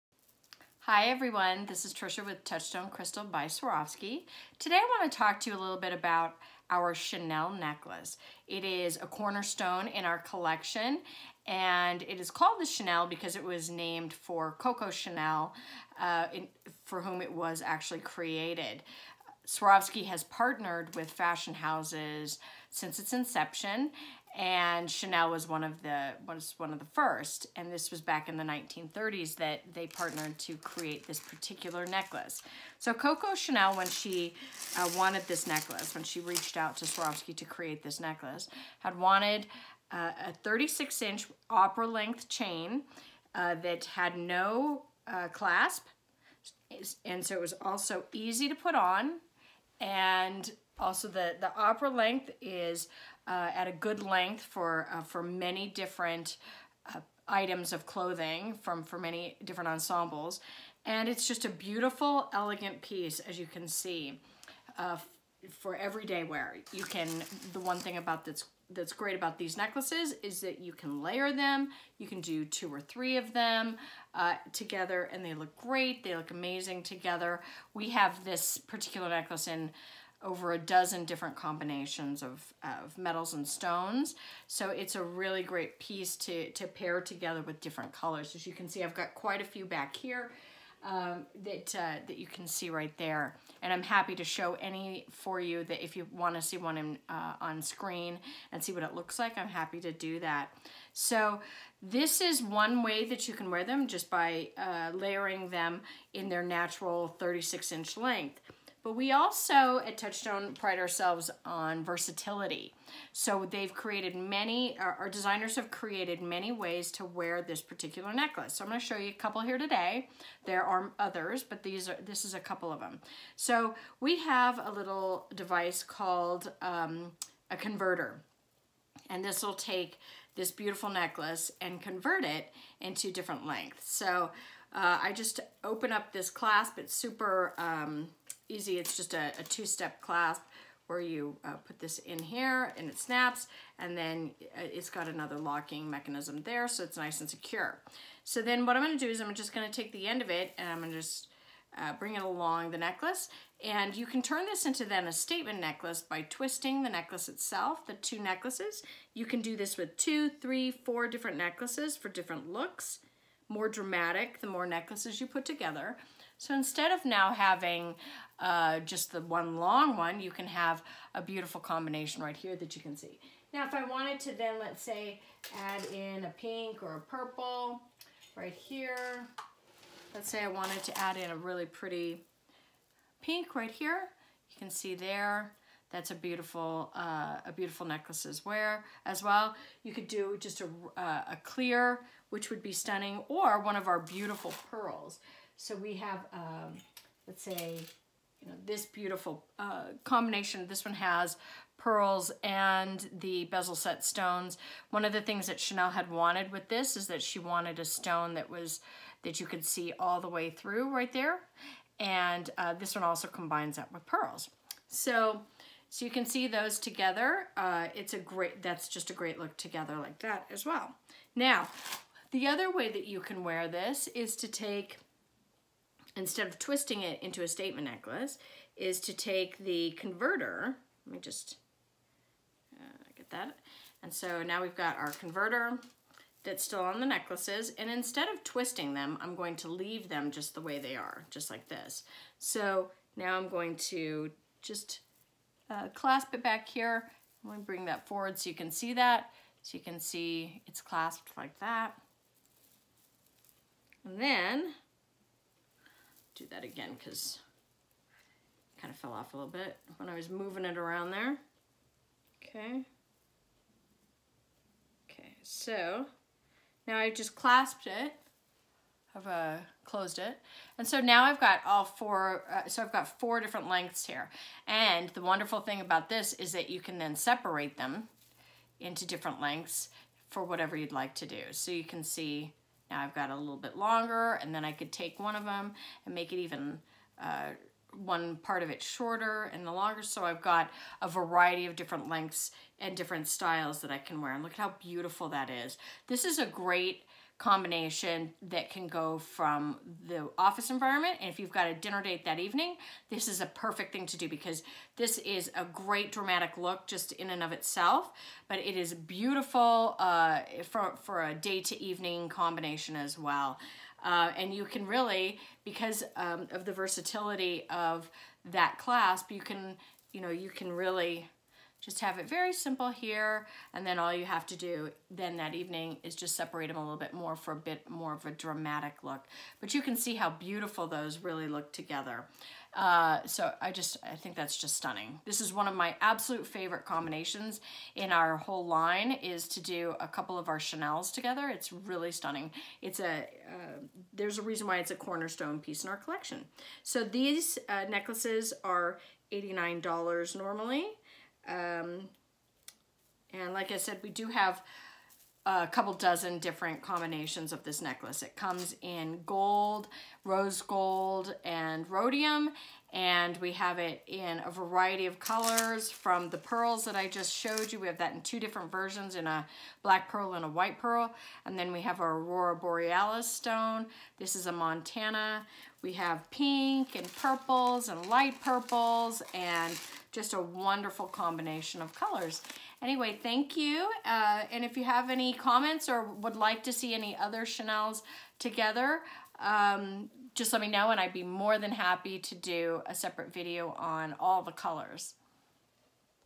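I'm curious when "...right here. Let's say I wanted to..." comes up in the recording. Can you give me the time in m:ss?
2:58.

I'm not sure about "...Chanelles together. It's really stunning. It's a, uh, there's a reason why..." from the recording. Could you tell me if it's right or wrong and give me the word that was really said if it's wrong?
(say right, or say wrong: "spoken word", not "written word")
right.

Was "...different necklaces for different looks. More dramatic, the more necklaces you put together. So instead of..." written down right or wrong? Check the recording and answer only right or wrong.
right.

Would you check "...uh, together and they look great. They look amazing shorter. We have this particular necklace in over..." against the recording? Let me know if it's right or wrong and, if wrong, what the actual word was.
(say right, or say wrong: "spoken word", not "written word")
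wrong: "together", not "shorter".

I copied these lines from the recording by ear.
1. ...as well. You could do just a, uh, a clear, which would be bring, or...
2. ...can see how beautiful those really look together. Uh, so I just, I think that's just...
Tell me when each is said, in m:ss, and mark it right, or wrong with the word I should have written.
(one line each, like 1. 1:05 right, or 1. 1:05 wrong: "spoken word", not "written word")
1. 3:09 wrong: "stunning", not "bring"
2. 5:29 right.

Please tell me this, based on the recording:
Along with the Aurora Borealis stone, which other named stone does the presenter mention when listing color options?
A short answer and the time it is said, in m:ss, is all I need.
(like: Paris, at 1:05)
Montana, at 6:14.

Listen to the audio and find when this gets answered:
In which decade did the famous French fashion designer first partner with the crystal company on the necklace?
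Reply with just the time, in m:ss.
0:28.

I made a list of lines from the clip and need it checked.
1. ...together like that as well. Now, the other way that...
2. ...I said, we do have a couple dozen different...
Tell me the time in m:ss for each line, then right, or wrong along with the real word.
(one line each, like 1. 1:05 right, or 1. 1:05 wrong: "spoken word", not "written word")
1. 3:39 right
2. 5:53 right.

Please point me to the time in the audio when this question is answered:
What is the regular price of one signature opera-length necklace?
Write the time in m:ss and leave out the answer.
5:49.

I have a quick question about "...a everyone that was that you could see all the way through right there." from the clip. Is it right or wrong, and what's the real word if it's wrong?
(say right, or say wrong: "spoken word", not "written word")
wrong: "stone", not "everyone".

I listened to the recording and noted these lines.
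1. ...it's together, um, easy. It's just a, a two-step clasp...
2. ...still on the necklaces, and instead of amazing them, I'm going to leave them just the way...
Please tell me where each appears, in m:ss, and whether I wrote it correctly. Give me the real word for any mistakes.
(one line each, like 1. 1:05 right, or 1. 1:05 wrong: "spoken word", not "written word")
1. 2:16 wrong: "super", not "together"
2. 3:56 wrong: "twisting", not "amazing".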